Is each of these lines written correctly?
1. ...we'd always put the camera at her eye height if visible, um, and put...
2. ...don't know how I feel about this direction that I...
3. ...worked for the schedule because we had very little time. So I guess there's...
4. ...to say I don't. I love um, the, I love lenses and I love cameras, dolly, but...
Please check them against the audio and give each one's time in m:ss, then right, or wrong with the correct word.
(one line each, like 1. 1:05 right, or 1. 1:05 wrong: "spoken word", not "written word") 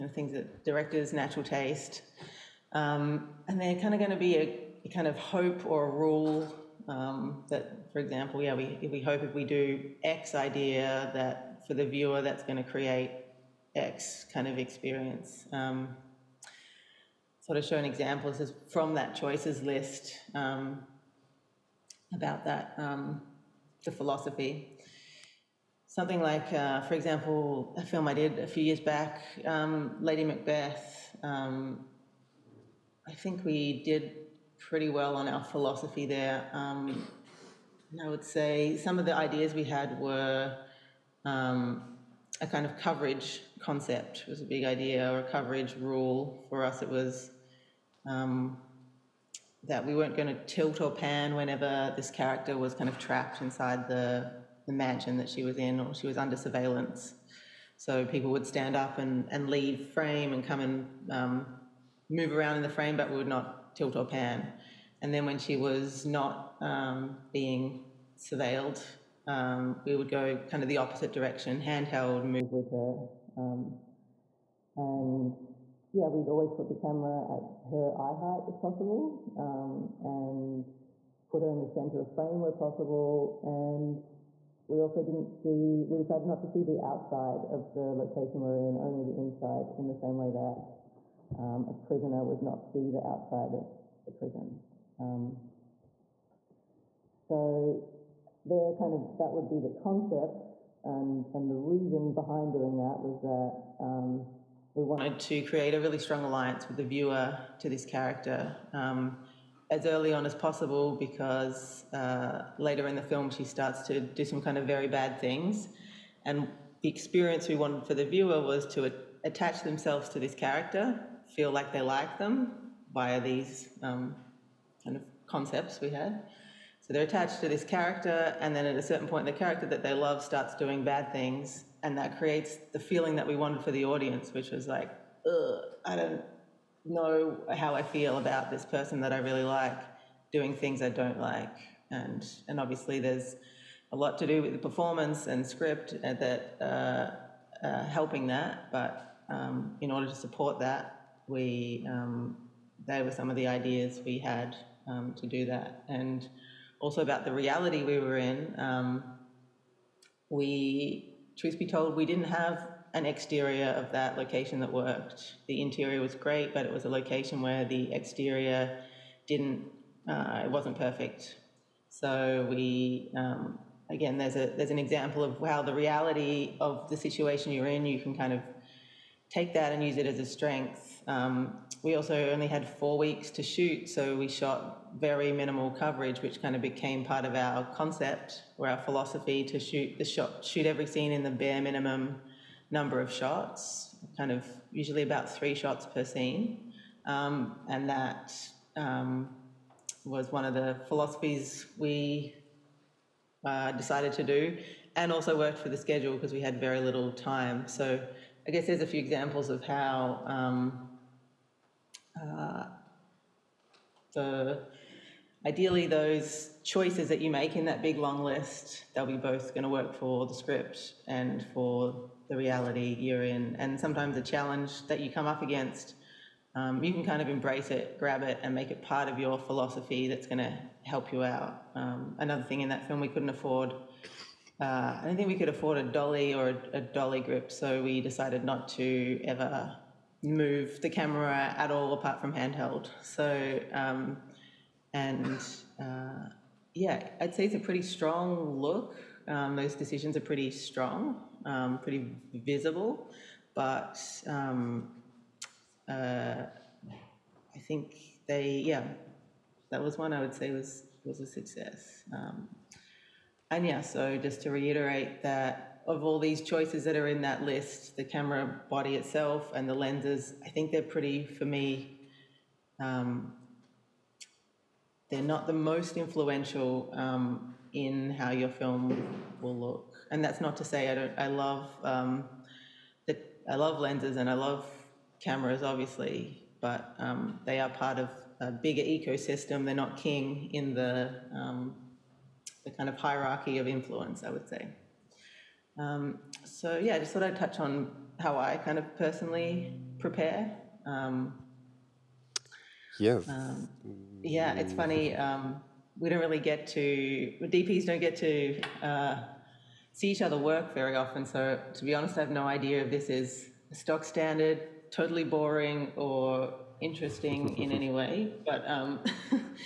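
1. 1:16 wrong: "possible", not "visible"
2. 2:15 wrong: "person", not "direction"
3. 3:25 right
4. 4:40 wrong: "obviously", not "dolly".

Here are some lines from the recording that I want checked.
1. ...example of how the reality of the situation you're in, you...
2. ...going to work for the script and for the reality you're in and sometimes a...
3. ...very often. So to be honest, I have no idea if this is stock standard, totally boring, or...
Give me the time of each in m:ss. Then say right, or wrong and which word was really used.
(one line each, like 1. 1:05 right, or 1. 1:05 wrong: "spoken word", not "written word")
1. 2:54 right
2. 3:39 right
3. 5:10 right.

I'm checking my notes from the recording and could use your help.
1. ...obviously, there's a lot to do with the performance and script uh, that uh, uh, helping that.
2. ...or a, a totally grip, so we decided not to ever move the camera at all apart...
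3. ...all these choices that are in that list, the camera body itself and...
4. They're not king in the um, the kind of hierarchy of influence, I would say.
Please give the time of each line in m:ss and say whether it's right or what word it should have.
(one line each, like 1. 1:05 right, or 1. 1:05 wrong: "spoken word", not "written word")
1. 2:22 right
2. 3:56 wrong: "dolly", not "totally"
3. 4:26 right
4. 4:49 right.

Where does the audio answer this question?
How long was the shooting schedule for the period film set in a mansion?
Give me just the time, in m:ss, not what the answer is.
3:02.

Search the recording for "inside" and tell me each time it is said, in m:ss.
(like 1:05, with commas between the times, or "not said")
0:53, 1:29.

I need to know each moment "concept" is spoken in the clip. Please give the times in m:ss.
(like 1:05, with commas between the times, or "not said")
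0:43, 1:39, 2:05, 3:07.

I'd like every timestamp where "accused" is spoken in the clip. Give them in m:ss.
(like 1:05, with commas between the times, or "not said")
not said.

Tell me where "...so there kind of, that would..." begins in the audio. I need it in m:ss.
1:37.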